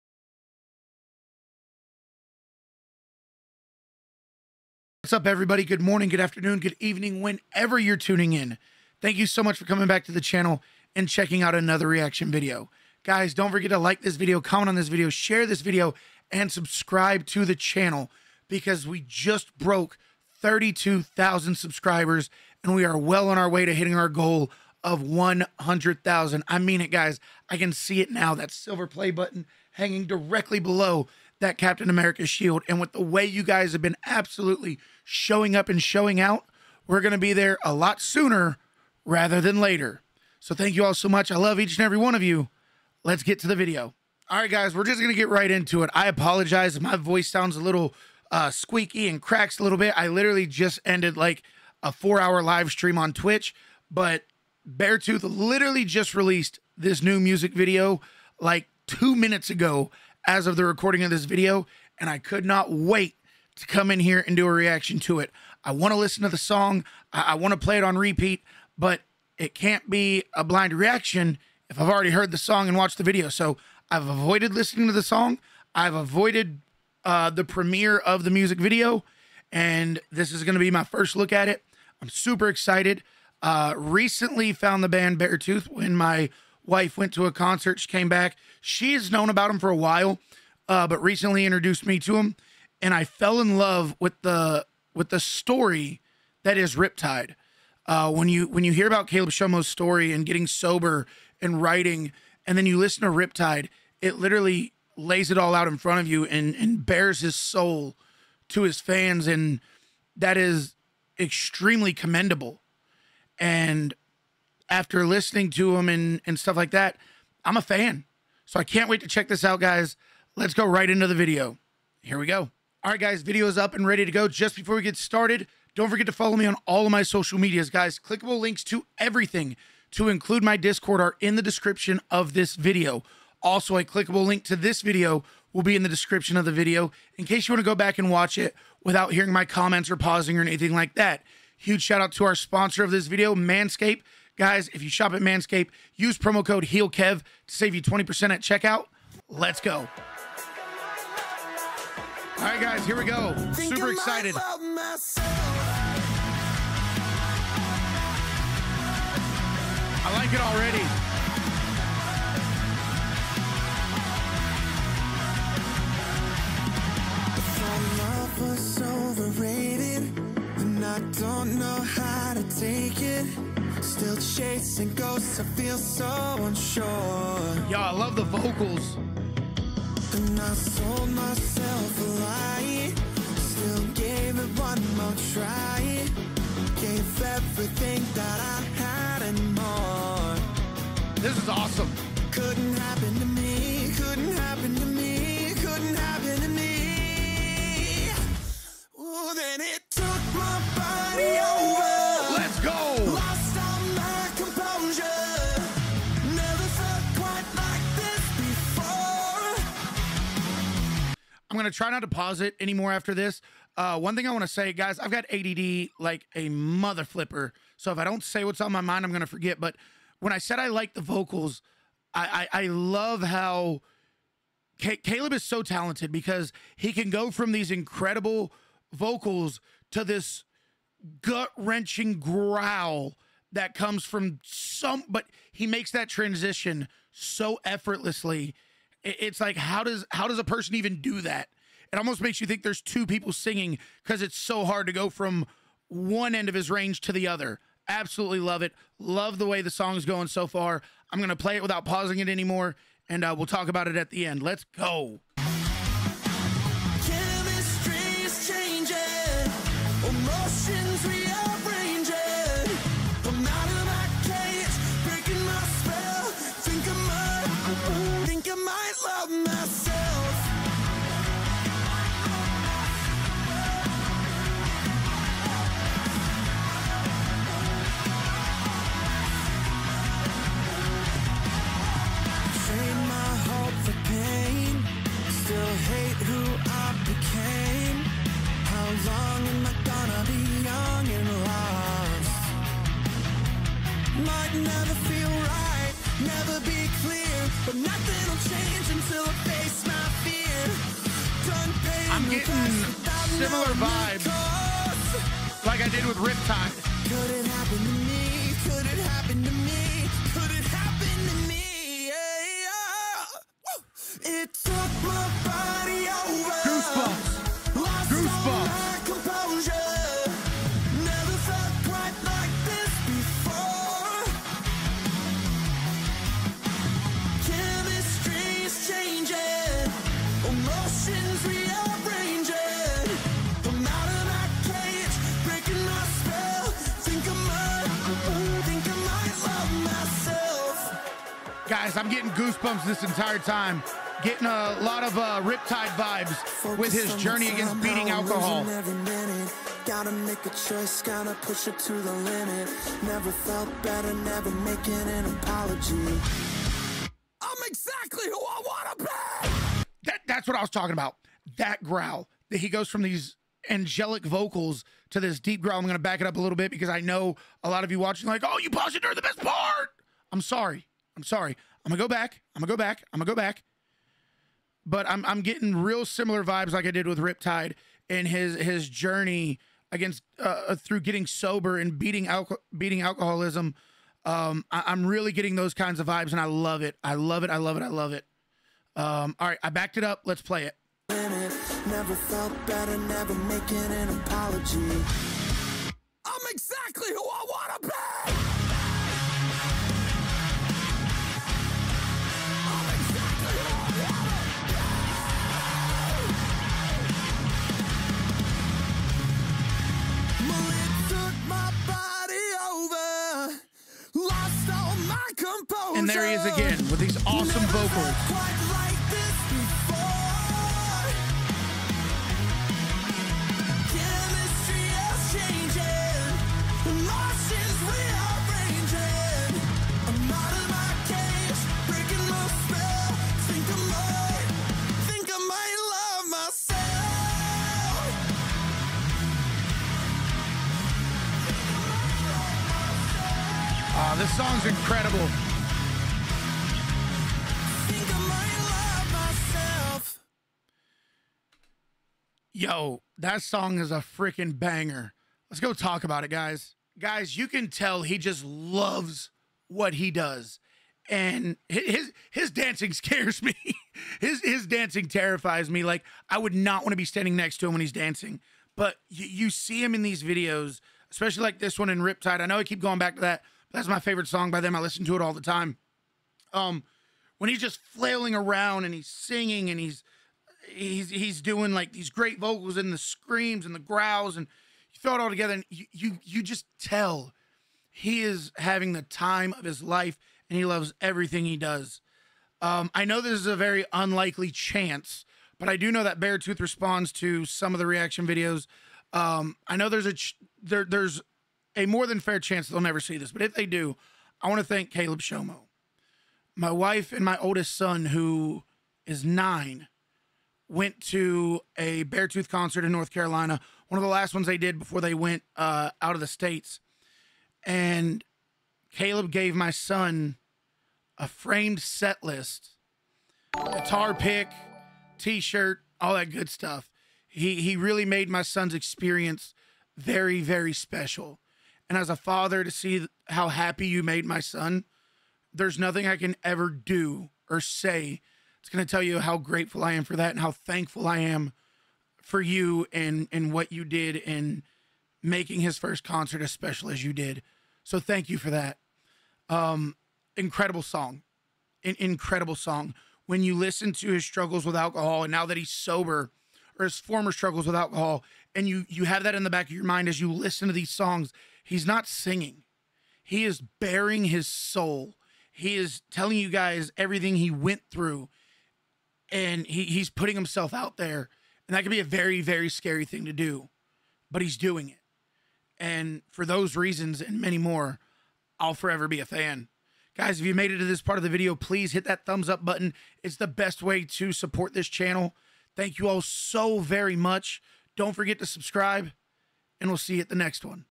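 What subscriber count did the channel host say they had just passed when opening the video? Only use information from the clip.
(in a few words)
32,000.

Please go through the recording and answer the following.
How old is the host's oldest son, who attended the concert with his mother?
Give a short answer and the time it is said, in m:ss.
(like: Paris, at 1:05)
9, at 8:29.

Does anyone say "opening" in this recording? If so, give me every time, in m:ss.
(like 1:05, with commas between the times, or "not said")
not said.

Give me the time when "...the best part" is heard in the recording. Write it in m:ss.
6:09.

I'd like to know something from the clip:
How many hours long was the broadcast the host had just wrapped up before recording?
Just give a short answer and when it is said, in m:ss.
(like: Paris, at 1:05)
4, at 0:51.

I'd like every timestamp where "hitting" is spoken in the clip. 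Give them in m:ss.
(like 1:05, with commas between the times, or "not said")
0:23.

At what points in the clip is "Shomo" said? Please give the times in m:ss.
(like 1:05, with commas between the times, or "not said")
1:39, 8:25.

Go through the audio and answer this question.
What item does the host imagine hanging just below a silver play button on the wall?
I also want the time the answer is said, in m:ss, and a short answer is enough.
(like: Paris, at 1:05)
Captain America shield, at 0:31.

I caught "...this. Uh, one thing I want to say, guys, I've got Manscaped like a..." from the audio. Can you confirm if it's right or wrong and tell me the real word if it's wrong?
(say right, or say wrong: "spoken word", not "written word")
wrong: "ADD", not "Manscaped".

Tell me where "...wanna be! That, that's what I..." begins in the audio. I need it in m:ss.
5:58.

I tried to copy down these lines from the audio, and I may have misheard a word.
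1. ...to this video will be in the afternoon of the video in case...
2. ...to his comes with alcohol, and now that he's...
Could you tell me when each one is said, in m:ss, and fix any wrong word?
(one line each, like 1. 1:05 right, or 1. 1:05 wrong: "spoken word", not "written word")
1. 2:14 wrong: "description", not "afternoon"
2. 9:13 wrong: "struggles", not "comes".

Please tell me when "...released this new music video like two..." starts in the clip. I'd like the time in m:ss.
0:56.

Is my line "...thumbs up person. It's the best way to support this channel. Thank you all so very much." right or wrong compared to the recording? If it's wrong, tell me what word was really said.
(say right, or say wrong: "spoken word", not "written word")
wrong: "button", not "person".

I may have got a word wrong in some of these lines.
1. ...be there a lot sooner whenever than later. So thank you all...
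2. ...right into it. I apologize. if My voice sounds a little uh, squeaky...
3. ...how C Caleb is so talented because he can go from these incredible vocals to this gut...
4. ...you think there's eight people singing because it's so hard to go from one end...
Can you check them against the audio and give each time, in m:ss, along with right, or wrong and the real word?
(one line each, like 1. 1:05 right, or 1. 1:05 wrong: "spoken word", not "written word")
1. 0:37 wrong: "rather", not "whenever"
2. 0:45 right
3. 3:43 right
4. 4:02 wrong: "two", not "eight".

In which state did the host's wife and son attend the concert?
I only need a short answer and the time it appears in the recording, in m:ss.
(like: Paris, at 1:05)
North Carolina, at 8:32.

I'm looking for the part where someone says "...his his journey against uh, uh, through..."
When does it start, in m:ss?
6:18.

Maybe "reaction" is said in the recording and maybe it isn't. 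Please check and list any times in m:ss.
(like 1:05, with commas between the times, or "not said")
0:11, 1:04, 1:10, 8:17.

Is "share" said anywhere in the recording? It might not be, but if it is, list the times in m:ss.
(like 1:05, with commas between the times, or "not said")
0:15.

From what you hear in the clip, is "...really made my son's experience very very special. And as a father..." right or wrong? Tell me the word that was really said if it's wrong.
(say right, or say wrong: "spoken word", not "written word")
right.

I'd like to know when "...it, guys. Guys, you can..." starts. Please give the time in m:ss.
7:36.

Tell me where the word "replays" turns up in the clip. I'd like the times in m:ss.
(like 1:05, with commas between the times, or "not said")
not said.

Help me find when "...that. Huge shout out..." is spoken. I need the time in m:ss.
2:20.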